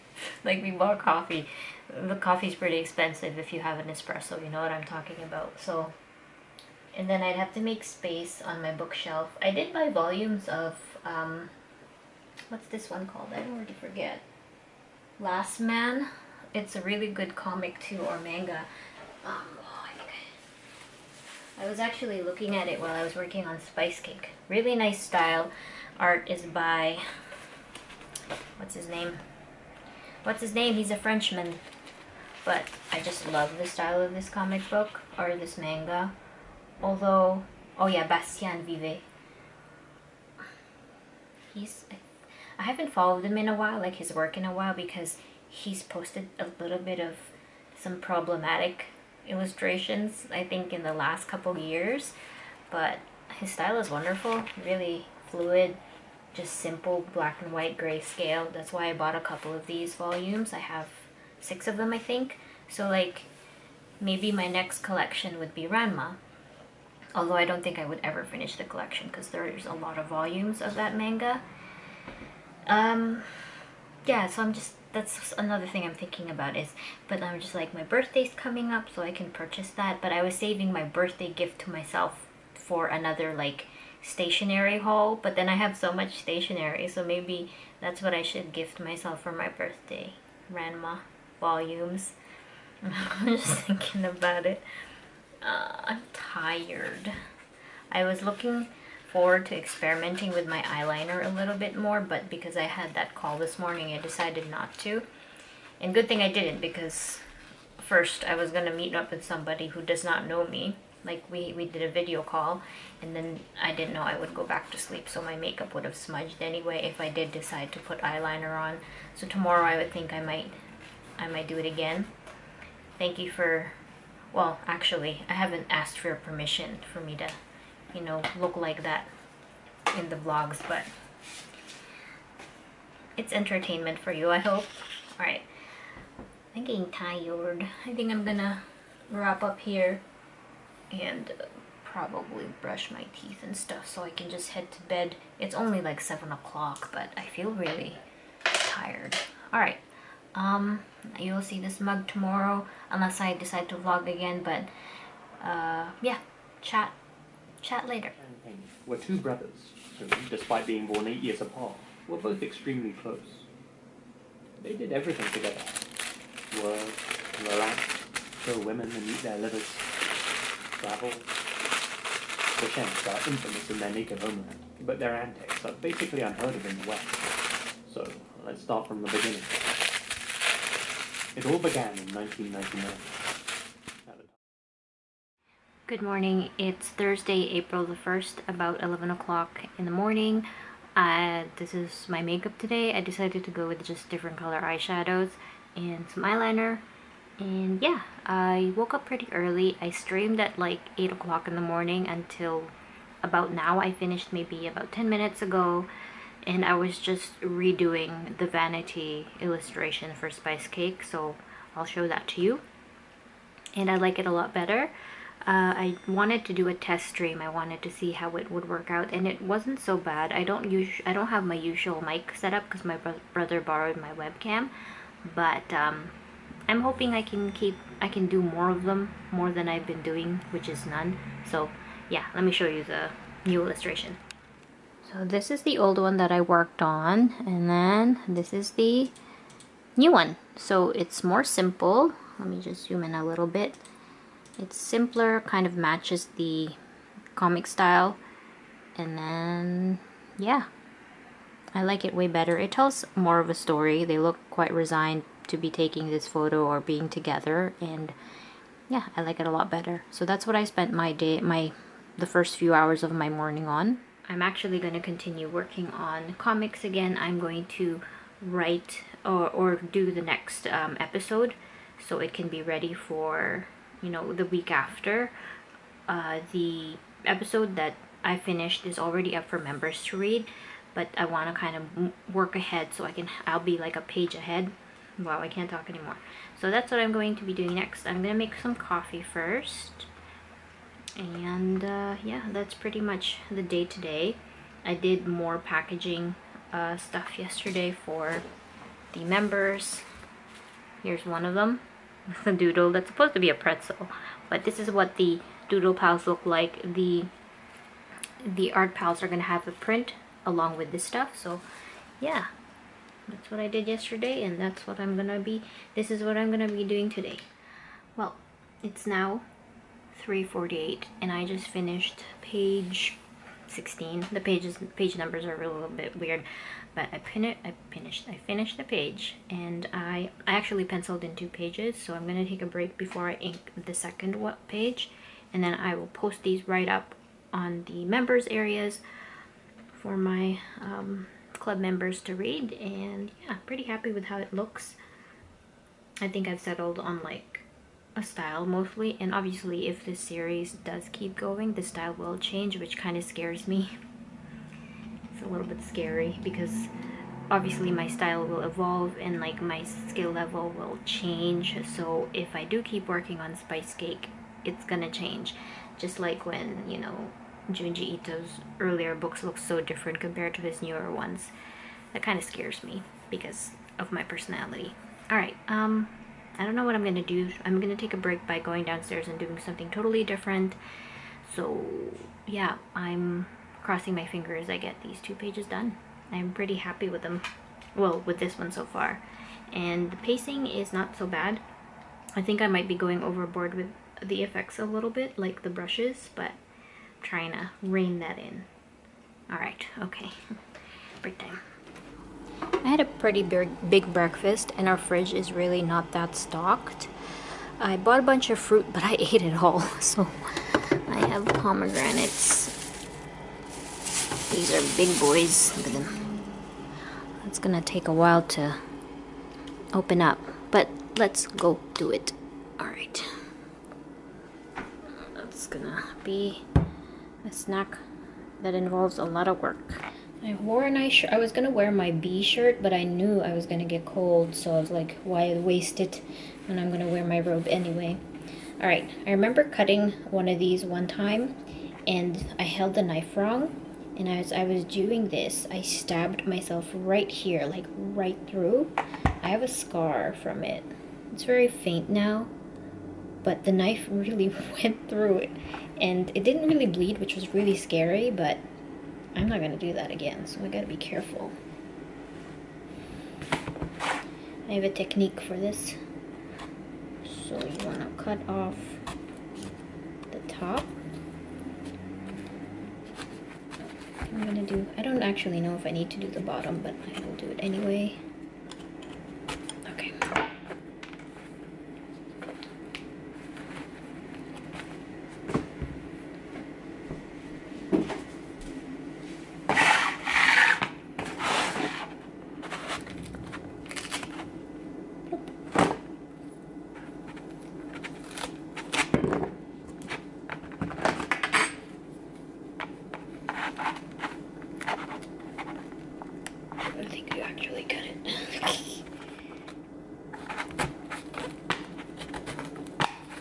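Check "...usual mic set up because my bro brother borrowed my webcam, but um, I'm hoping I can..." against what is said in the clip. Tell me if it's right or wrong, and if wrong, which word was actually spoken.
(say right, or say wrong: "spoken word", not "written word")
right.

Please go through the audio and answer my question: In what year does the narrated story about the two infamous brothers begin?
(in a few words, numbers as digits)
1999.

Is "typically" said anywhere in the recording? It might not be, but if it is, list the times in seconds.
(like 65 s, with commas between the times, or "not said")
not said.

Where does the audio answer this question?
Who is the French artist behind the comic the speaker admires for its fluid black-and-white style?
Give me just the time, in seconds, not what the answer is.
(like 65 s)
38 s.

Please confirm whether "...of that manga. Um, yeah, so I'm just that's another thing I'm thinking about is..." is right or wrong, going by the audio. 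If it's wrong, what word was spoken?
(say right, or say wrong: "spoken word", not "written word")
right.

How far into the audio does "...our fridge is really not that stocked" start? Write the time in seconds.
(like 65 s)
404 s.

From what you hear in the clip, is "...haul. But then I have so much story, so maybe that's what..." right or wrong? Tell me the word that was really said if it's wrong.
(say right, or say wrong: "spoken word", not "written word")
wrong: "stationery", not "story".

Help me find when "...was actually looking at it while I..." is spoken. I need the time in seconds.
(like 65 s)
21 s.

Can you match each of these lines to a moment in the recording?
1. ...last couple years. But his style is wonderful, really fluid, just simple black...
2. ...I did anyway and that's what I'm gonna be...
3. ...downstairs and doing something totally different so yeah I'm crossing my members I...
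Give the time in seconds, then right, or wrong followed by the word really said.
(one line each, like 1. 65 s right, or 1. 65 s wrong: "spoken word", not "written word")
1. 50 s right
2. 313 s wrong: "yesterday", not "anyway"
3. 378 s wrong: "fingers", not "members".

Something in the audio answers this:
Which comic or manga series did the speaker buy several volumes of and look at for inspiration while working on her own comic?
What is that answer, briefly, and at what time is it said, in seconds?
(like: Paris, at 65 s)
Last Man, at 15 s.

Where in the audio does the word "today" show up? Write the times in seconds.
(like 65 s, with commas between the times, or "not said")
192 s, 293 s, 317 s.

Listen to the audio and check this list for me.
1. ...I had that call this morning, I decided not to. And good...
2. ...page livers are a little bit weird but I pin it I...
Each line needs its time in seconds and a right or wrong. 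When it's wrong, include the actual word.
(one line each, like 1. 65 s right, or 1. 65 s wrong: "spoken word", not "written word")
1. 102 s right
2. 324 s wrong: "numbers", not "livers".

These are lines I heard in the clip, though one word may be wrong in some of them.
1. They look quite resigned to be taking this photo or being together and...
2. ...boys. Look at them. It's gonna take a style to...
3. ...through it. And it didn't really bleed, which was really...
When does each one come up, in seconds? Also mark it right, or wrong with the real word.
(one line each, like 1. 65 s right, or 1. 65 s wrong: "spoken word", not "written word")
1. 254 s right
2. 415 s wrong: "while", not "style"
3. 455 s right.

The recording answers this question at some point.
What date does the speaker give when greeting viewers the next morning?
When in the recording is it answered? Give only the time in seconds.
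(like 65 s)
187 s.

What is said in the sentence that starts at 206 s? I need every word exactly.
And I was just redoing the vanity illustration for Spice Cake.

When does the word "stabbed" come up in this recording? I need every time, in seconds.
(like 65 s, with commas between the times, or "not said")
445 s.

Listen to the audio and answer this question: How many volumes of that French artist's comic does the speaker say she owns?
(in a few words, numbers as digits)
6.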